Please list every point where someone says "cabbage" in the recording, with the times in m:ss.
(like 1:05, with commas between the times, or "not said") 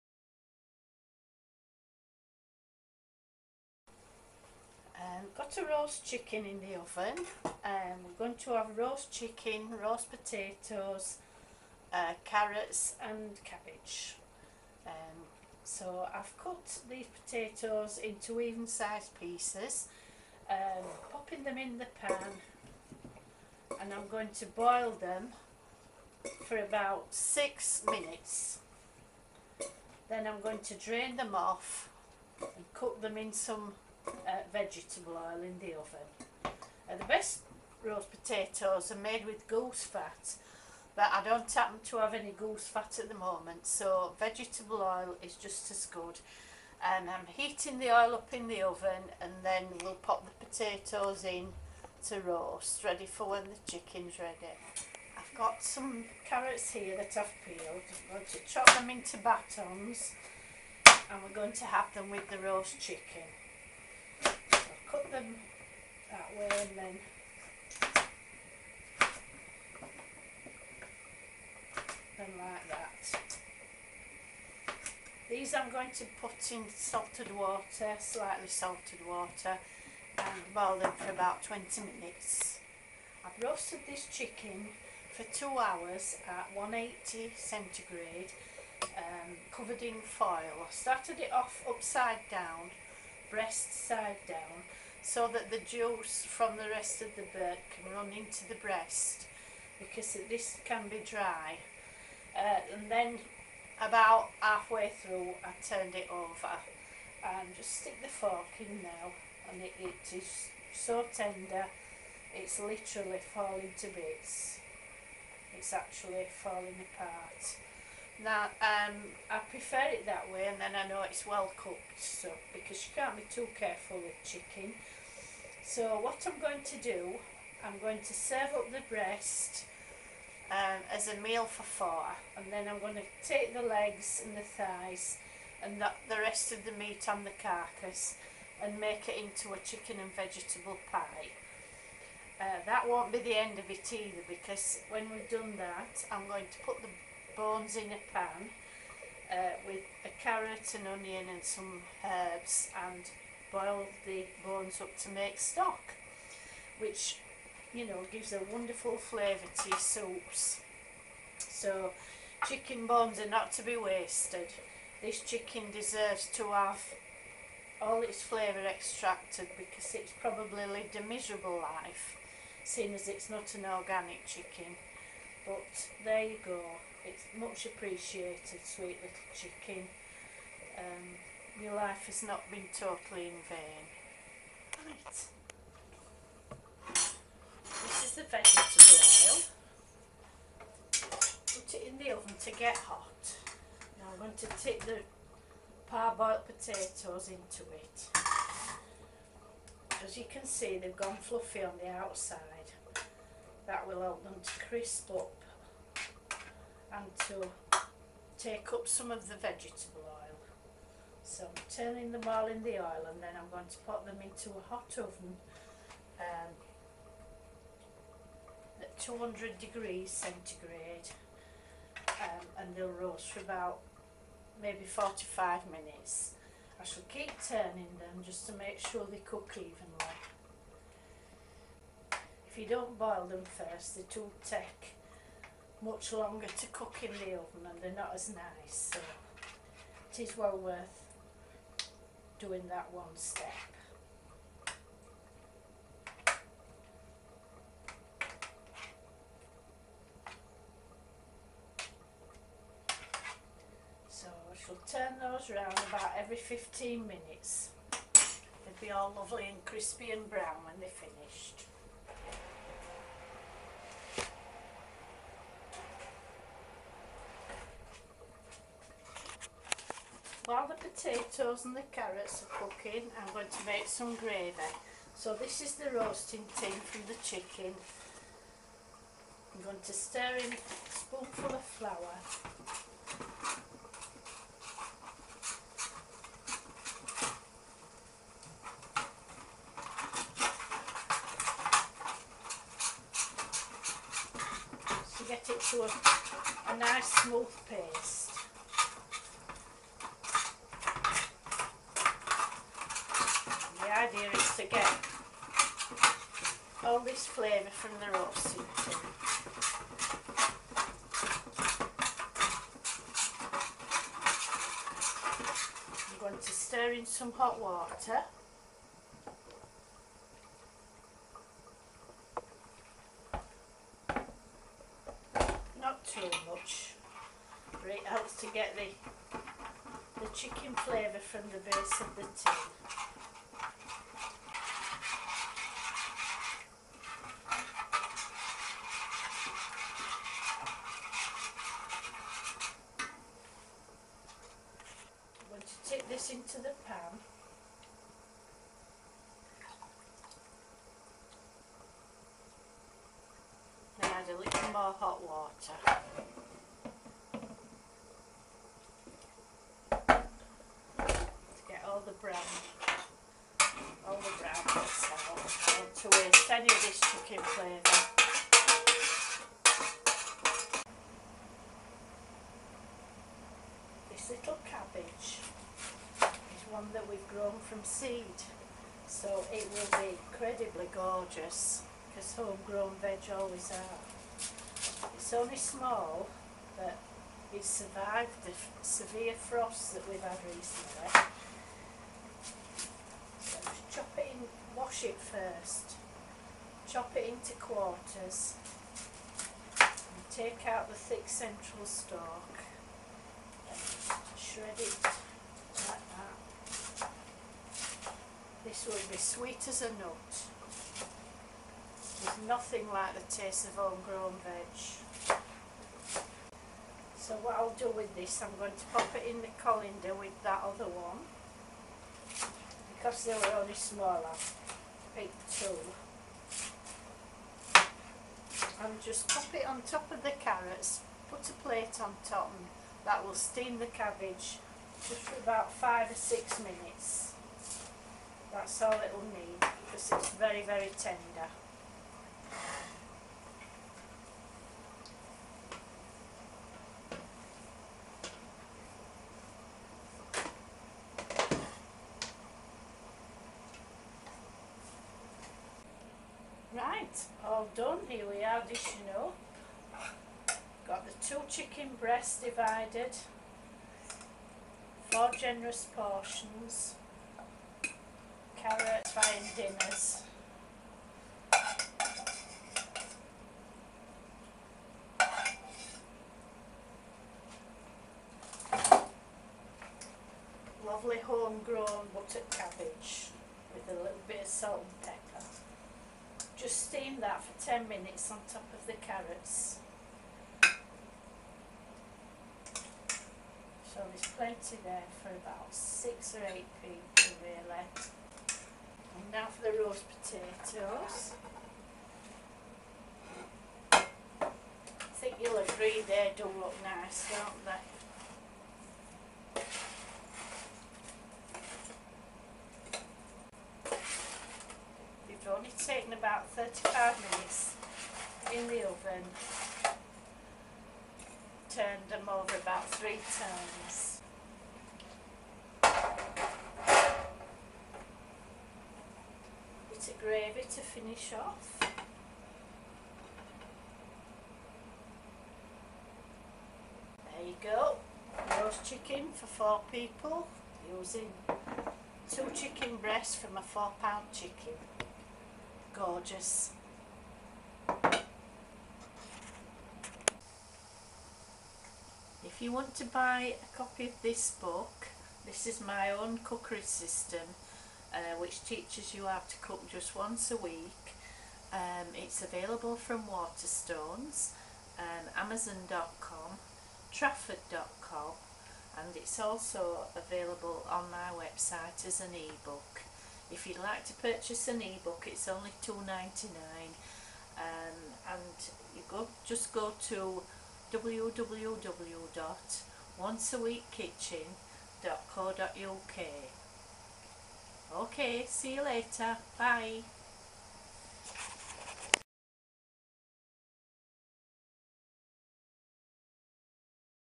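0:13, 6:14, 7:13, 8:02.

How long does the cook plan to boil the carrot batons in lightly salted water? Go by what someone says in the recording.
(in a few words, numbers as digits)
20 minutes.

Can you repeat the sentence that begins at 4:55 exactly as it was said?
So get it to a, a nice smooth paste.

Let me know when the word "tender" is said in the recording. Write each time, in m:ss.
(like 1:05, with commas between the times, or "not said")
1:51, 7:20.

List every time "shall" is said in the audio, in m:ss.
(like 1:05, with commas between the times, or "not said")
3:46, 4:14.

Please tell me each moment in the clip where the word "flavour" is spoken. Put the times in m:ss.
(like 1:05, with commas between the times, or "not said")
2:38, 2:48, 5:07, 5:30, 6:07.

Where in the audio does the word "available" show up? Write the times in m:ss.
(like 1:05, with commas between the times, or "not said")
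9:22, 9:30.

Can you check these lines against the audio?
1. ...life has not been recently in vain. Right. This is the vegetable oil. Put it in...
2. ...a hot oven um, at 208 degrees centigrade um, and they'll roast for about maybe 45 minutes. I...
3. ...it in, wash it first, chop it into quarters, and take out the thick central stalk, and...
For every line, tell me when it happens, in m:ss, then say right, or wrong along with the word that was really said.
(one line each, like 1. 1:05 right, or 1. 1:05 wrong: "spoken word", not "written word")
1. 3:01 wrong: "totally", not "recently"
2. 3:34 wrong: "200", not "208"
3. 6:34 right.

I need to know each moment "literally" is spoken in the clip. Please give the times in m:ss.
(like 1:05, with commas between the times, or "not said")
1:52.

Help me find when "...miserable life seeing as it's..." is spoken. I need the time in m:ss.
2:51.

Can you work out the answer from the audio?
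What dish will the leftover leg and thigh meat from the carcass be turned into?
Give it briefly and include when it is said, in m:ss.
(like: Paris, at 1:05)
Chicken and vegetable pie, at 2:19.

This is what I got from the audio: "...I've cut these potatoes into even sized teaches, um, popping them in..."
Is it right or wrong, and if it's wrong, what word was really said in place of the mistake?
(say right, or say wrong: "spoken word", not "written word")
wrong: "pieces", not "teaches".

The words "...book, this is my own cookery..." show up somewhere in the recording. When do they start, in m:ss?
9:14.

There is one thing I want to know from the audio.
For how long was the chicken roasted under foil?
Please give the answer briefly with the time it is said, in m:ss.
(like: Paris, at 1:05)
2 hours, at 1:25.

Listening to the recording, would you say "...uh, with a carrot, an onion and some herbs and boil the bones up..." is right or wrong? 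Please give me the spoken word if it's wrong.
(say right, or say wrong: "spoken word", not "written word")
right.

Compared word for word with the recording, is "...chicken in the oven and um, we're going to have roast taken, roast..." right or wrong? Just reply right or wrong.
wrong.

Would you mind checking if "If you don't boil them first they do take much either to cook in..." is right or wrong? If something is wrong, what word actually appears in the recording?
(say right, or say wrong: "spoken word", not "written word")
wrong: "longer", not "either".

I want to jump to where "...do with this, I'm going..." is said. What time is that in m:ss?
6:57.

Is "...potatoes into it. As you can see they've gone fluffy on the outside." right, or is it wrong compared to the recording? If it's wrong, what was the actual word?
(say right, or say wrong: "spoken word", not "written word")
right.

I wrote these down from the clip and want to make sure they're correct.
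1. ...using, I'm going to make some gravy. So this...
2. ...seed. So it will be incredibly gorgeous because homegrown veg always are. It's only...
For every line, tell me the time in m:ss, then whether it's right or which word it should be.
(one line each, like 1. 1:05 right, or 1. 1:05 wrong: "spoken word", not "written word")
1. 4:32 wrong: "cooking", not "using"
2. 6:17 right.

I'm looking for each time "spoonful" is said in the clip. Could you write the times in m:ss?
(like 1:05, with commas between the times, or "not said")
4:40.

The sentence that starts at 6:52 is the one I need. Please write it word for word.
There's nothing like the taste of homegrown veg.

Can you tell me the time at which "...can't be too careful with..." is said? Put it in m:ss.
2:02.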